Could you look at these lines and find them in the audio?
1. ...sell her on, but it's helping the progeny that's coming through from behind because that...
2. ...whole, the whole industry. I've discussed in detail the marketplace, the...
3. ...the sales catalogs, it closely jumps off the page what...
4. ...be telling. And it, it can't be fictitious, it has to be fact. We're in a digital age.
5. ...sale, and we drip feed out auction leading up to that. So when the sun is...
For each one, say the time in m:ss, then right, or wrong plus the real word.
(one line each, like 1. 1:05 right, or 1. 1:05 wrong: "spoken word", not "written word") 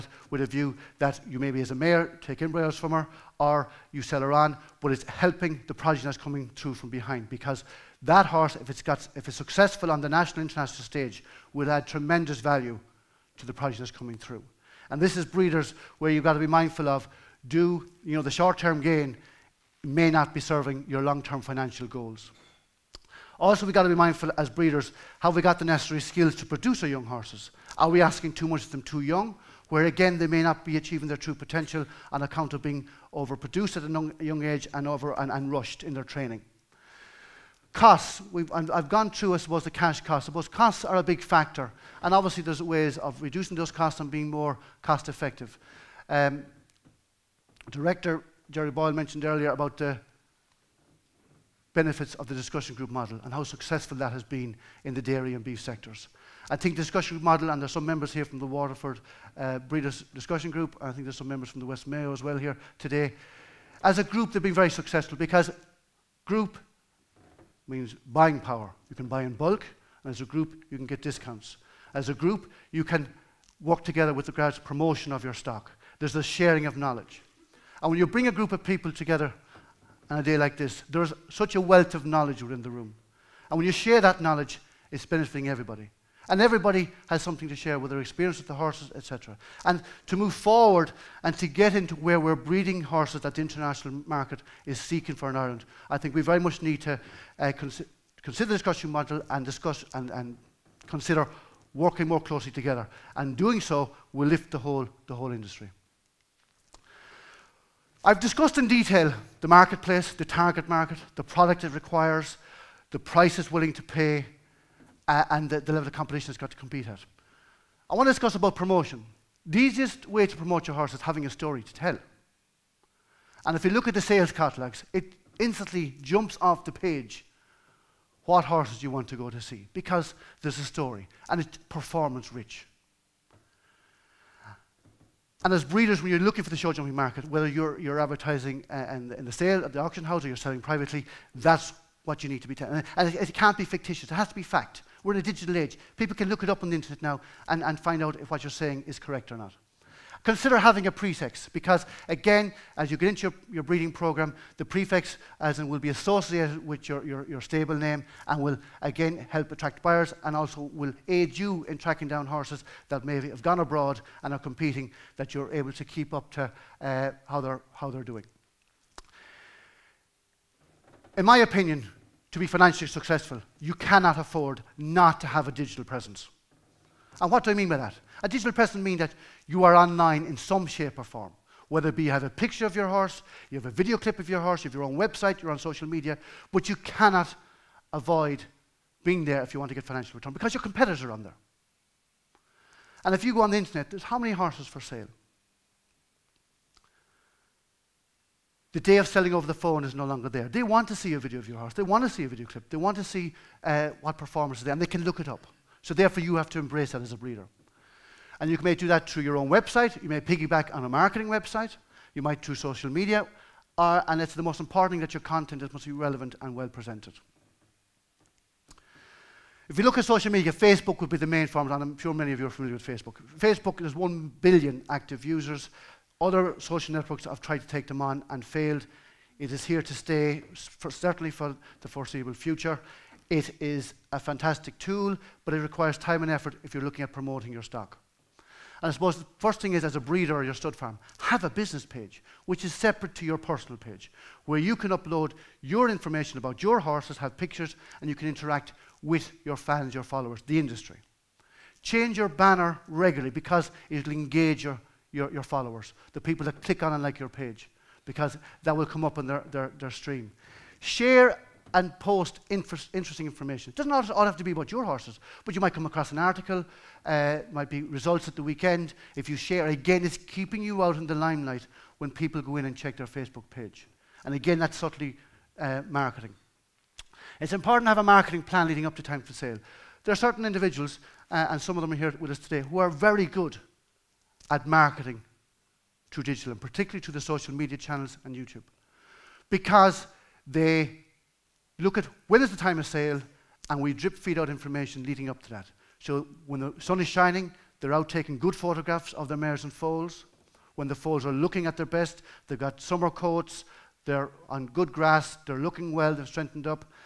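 1. 0:03 right
2. 1:44 right
3. 2:03 wrong: "instantly", not "closely"
4. 2:22 right
5. 4:52 wrong: "information", not "auction".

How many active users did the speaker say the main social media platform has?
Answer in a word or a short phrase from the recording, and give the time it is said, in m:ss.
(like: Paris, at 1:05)
1 billion, at 3:43.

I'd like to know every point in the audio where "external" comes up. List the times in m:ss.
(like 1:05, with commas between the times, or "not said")
not said.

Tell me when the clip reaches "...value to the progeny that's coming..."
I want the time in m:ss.
0:12.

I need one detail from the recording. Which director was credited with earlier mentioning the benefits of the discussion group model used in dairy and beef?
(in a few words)
Gerry Boyle.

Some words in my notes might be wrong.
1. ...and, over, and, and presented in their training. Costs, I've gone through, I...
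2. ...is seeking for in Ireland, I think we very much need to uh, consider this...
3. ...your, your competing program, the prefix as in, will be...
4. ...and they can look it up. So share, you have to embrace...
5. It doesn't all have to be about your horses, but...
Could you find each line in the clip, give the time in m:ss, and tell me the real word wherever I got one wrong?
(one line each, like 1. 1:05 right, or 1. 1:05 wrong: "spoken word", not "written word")
1. 0:34 wrong: "rushed", not "presented"
2. 1:34 right
3. 2:33 wrong: "breeding", not "competing"
4. 3:24 wrong: "therefore", not "share"
5. 4:23 right.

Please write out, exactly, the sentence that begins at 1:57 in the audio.
I want to discuss about promotion.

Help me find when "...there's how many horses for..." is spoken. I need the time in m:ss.
3:13.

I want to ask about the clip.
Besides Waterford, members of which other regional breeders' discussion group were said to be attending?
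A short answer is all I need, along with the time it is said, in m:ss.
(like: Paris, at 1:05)
West Mayo, at 1:01.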